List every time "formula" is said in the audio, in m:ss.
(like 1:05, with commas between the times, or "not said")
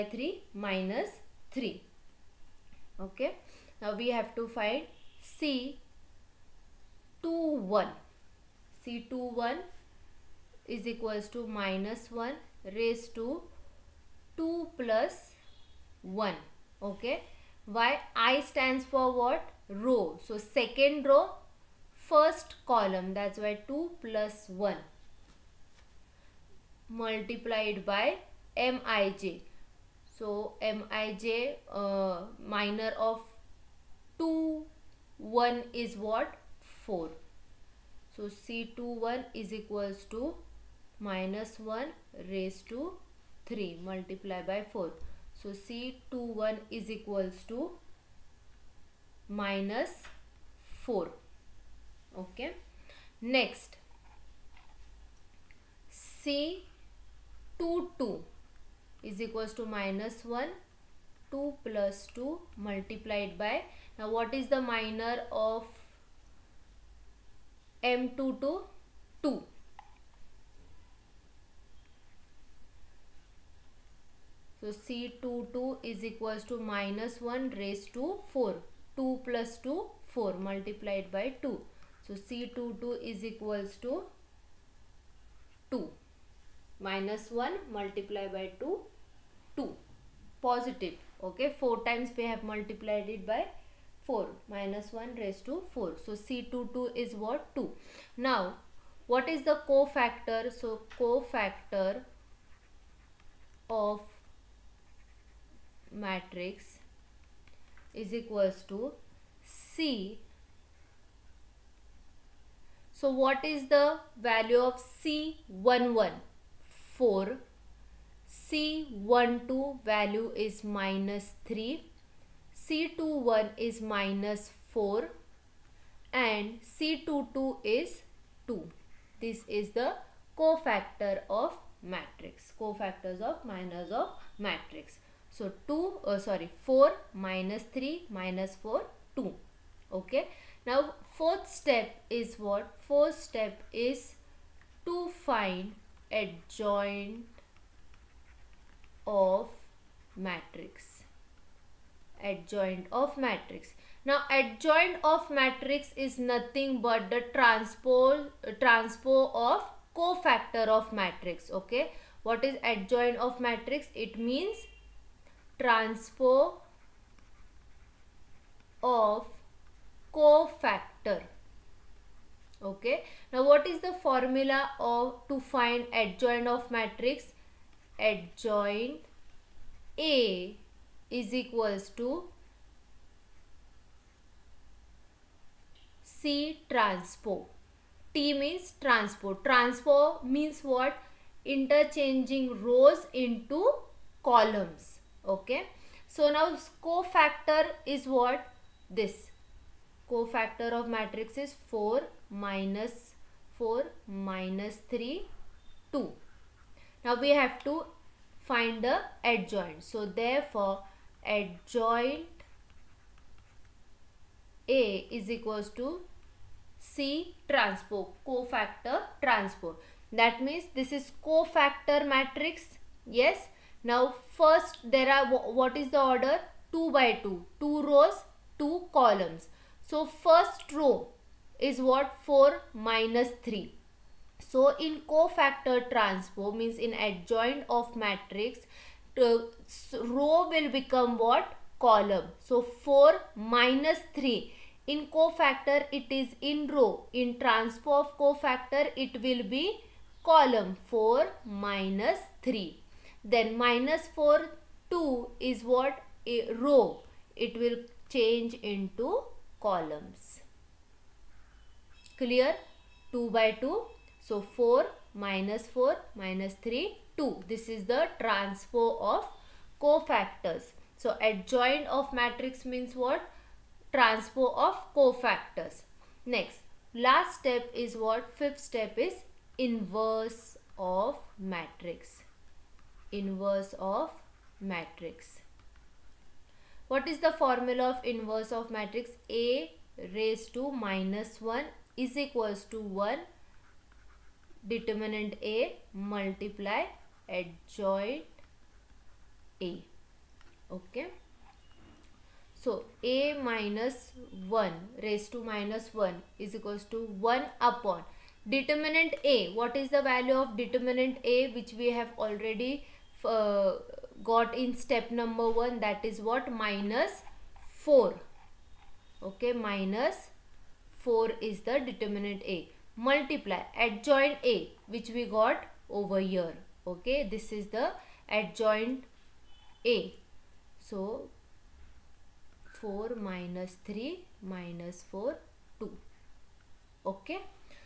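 2:54, 4:47.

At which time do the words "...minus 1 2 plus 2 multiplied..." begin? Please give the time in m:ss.
0:59.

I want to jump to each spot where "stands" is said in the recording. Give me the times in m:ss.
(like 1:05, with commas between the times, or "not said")
0:18.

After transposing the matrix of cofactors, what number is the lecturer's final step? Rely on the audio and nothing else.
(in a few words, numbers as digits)
Fifth.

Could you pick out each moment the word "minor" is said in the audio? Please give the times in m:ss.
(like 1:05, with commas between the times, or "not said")
0:32, 1:04, 2:13.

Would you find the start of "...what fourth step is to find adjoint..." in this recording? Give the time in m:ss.
2:22.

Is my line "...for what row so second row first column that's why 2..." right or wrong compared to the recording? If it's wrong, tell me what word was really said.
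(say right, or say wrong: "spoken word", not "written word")
right.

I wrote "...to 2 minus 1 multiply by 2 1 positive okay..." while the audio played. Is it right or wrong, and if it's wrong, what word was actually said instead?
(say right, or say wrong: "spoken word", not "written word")
wrong: "2", not "1".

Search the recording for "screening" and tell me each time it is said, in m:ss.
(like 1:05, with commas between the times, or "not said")
not said.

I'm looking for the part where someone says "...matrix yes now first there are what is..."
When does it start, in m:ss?
3:42.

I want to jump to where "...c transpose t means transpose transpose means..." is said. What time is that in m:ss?
3:06.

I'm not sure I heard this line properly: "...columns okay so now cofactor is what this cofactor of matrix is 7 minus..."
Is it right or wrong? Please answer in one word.
wrong.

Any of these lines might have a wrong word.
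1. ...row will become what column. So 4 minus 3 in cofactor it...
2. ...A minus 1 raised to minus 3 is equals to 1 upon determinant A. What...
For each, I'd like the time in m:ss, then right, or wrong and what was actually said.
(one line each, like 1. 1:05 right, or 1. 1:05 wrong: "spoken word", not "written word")
1. 4:00 right
2. 5:03 wrong: "1", not "3".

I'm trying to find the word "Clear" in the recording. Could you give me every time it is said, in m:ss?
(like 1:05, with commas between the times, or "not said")
4:22.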